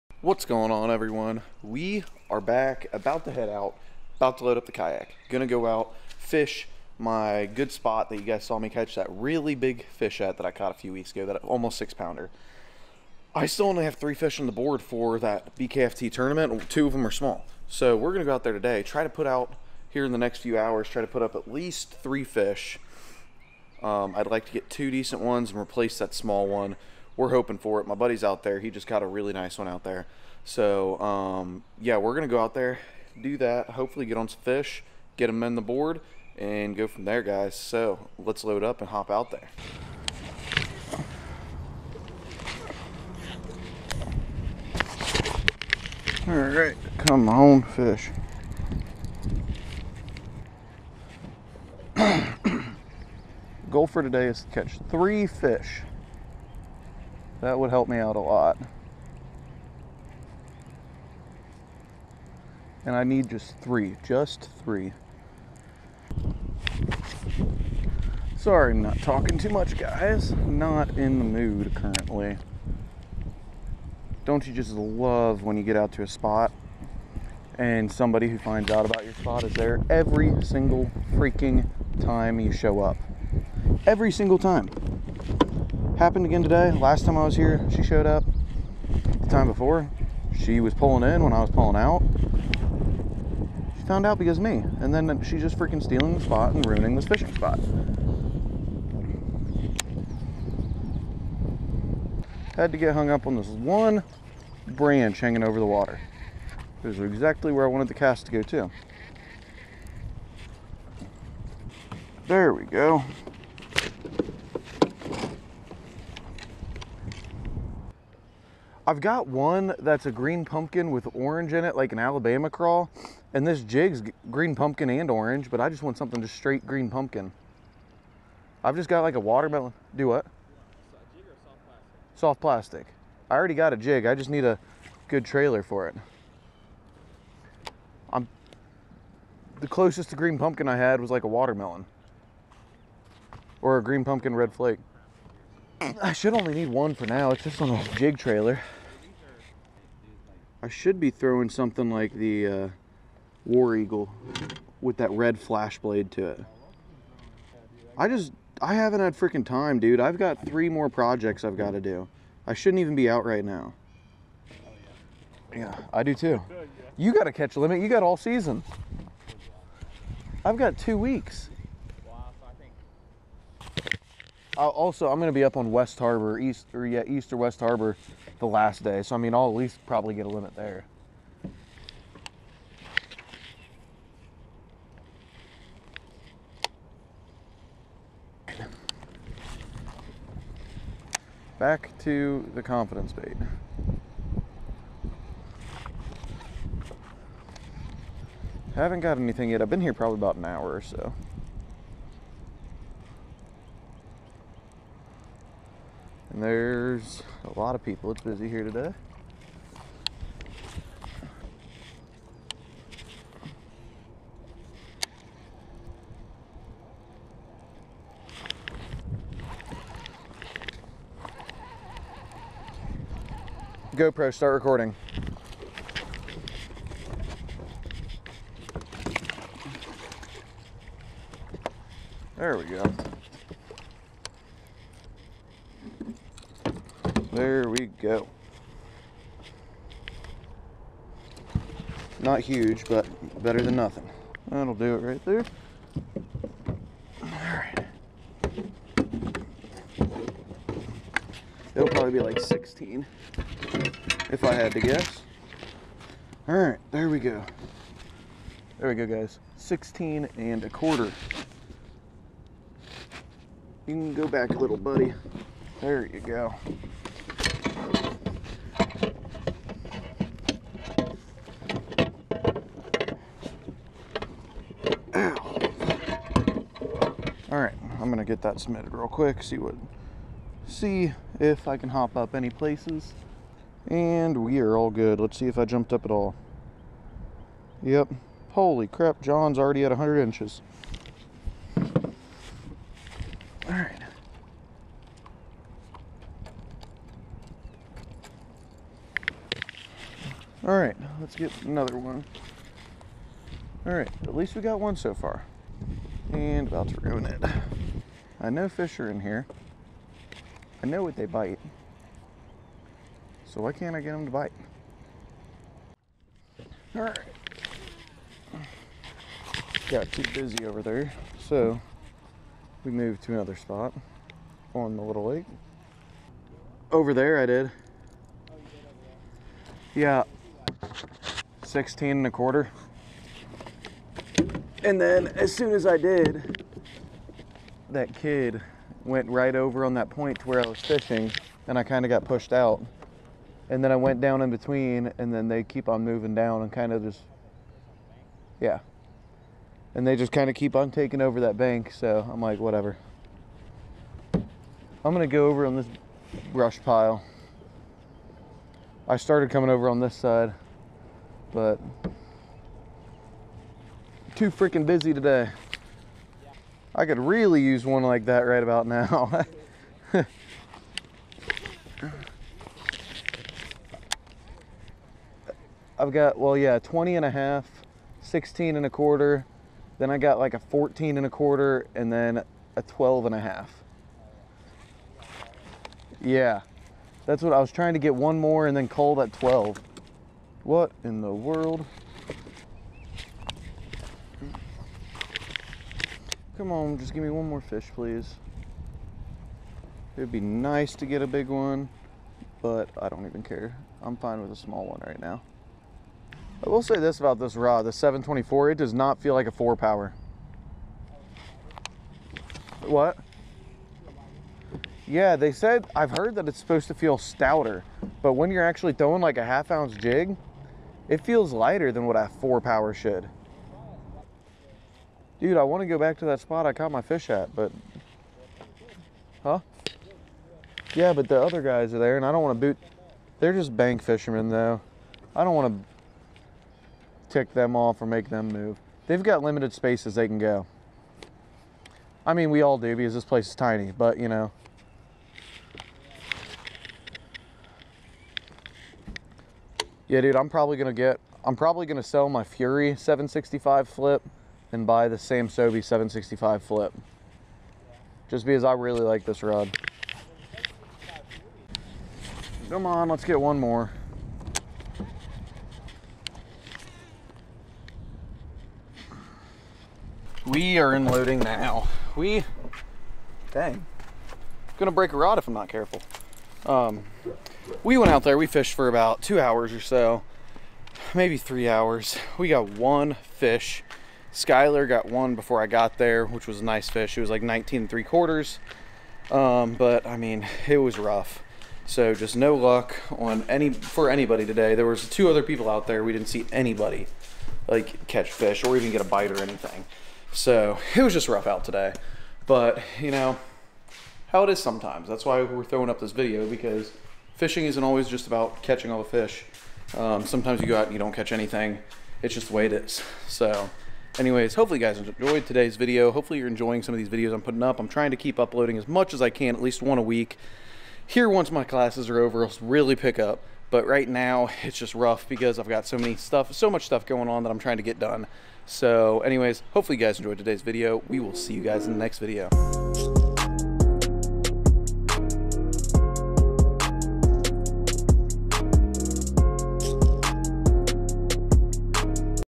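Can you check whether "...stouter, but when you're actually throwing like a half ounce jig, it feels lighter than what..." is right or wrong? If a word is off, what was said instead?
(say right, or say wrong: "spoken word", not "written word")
right.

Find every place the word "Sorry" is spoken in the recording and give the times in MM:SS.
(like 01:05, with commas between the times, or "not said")
01:08.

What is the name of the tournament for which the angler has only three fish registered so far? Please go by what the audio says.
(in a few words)
BKFT.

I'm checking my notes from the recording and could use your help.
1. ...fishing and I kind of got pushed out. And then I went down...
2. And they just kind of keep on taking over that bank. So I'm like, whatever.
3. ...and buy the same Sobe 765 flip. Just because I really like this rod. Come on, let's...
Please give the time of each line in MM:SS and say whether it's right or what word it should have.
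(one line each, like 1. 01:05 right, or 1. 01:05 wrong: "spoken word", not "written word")
1. 05:40 right
2. 05:49 right
3. 07:34 right.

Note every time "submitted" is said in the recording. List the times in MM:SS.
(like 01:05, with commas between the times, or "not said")
04:38.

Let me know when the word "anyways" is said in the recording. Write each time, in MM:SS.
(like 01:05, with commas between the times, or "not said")
08:34, 08:49.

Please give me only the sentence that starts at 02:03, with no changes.
And this jig's green pumpkin and orange, but I just want something just straight green pumpkin.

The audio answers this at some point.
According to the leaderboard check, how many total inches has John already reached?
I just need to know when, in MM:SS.
04:49.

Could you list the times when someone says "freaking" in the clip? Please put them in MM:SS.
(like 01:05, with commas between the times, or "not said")
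01:21, 01:35, 02:39, 06:04.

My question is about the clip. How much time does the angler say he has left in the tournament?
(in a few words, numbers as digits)
2 weeks.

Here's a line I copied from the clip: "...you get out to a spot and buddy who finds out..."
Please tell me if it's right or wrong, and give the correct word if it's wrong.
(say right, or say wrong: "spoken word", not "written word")
wrong: "somebody", not "buddy".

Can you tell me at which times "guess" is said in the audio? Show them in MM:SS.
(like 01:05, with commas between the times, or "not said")
04:14.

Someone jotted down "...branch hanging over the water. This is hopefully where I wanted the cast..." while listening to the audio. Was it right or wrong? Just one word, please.
wrong.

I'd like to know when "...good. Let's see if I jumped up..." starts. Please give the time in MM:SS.
04:44.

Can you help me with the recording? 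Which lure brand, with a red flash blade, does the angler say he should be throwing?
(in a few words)
War Eagle.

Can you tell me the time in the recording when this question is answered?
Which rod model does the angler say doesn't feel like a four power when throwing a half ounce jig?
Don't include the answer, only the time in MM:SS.
06:47.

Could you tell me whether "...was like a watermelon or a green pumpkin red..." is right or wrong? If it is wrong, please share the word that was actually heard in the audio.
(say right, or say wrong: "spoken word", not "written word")
right.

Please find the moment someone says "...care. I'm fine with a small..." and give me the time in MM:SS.
06:43.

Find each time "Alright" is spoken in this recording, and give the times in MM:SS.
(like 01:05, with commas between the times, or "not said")
04:07, 04:16.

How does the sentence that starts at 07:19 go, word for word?
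They've got limited spaces they can go.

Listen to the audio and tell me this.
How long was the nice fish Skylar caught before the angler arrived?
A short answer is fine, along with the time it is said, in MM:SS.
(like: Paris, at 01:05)
19 3/4 inches, at 08:07.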